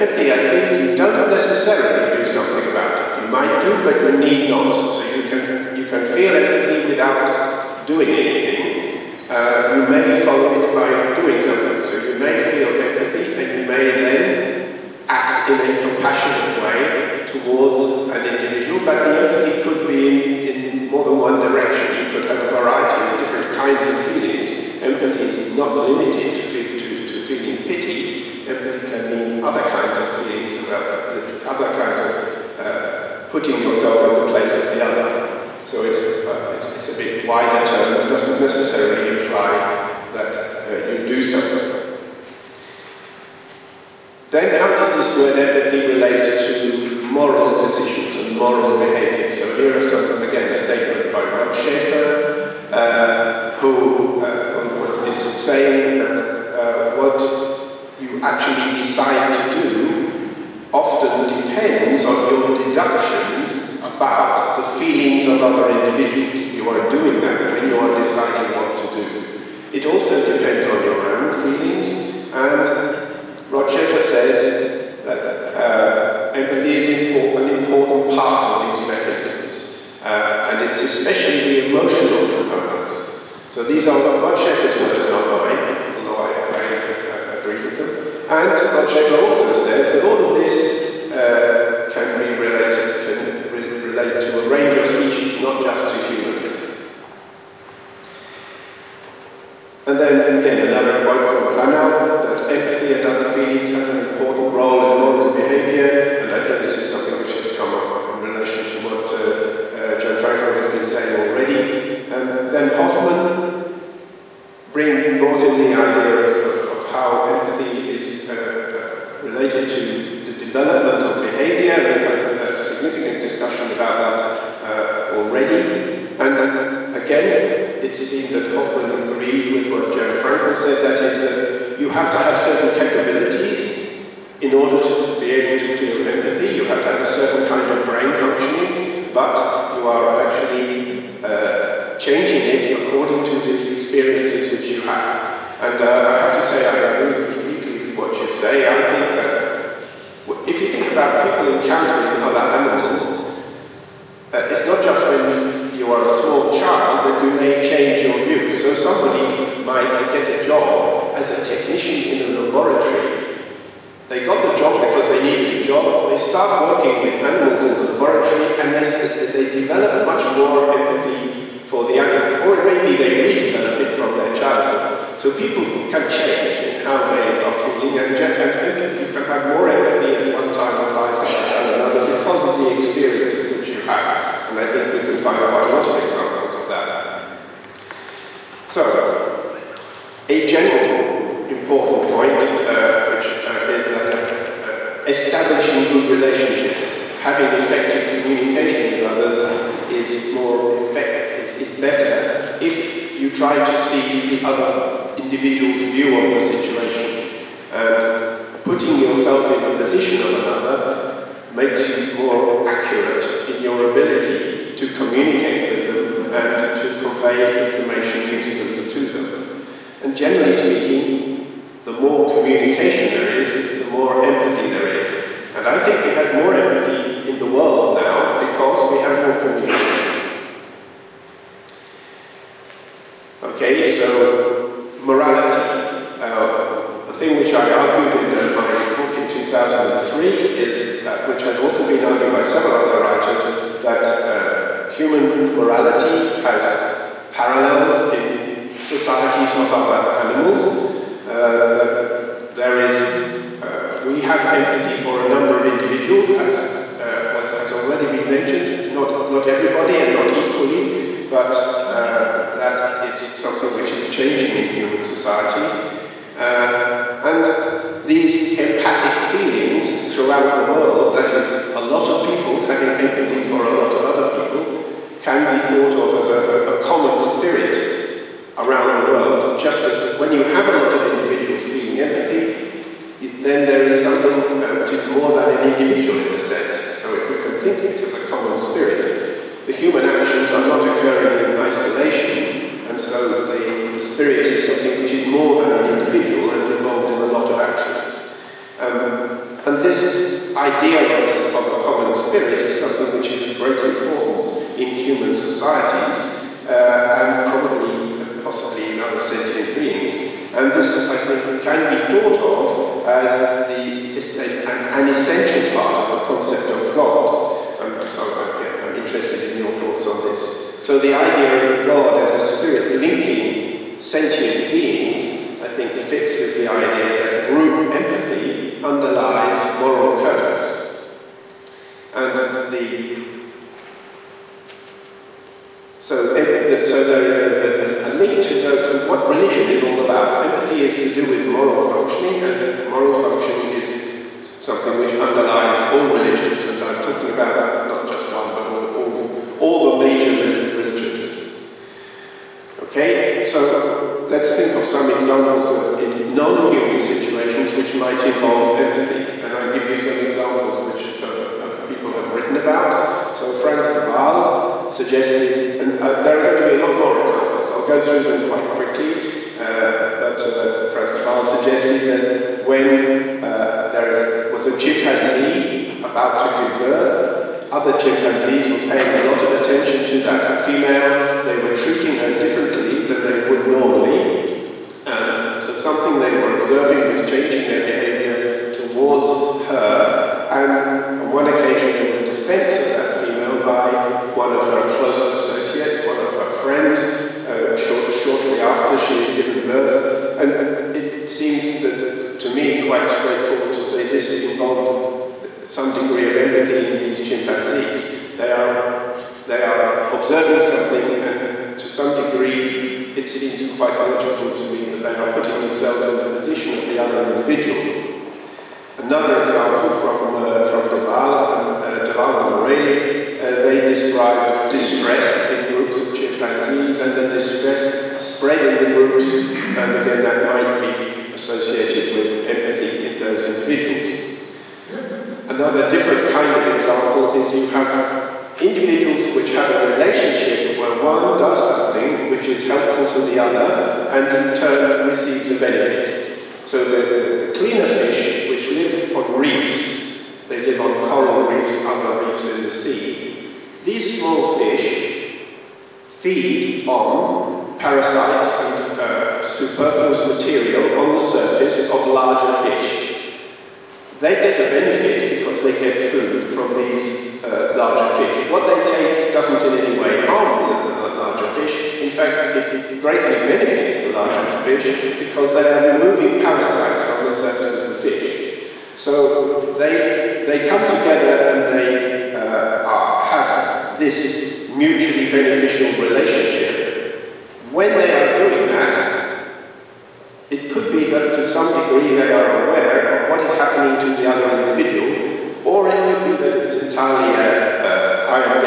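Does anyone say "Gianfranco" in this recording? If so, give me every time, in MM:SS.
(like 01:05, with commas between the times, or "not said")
01:49, 02:09.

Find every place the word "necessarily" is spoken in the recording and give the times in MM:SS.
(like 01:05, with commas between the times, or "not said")
00:01, 00:38.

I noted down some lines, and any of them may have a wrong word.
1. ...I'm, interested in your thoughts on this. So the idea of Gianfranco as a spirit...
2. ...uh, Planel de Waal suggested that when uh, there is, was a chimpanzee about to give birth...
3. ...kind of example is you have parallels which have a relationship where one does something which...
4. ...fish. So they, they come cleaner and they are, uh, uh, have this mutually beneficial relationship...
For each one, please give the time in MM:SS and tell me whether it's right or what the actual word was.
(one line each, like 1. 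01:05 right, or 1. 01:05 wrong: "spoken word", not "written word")
1. 05:18 wrong: "God", not "Gianfranco"
2. 06:10 wrong: "Frans", not "Planel"
3. 07:16 wrong: "individuals", not "parallels"
4. 07:57 wrong: "together", not "cleaner".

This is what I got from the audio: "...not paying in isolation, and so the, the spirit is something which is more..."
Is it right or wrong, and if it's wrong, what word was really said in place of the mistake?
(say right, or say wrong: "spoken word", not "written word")
wrong: "occurring", not "paying".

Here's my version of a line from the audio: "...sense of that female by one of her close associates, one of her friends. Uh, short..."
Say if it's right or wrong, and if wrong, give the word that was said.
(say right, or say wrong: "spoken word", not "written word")
wrong: "defense", not "sense".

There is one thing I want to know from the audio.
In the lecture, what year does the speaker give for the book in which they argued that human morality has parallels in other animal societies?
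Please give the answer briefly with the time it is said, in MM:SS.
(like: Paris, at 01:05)
2003, at 03:59.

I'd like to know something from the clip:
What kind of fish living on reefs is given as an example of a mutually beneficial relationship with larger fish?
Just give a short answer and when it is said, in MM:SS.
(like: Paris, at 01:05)
Cleaner fish, at 07:27.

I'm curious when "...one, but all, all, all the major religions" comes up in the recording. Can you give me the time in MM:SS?
05:48.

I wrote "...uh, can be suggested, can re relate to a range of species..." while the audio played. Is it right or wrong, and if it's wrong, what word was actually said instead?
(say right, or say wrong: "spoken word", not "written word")
wrong: "related", not "suggested".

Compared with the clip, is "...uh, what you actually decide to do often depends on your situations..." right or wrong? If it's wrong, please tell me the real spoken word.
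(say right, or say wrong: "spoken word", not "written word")
wrong: "deductions", not "situations".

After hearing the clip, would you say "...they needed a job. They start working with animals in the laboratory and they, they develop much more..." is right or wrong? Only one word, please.
right.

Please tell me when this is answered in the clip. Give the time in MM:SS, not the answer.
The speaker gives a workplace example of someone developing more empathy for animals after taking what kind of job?
02:41.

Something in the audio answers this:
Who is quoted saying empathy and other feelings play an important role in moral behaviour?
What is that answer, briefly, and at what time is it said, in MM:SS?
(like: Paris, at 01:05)
Planel, at 01:41.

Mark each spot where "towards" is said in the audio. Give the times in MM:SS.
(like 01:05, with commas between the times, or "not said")
00:17, 06:28.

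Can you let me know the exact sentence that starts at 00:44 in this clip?
Then how does this word empathy relate to moral decisions and moral behavior?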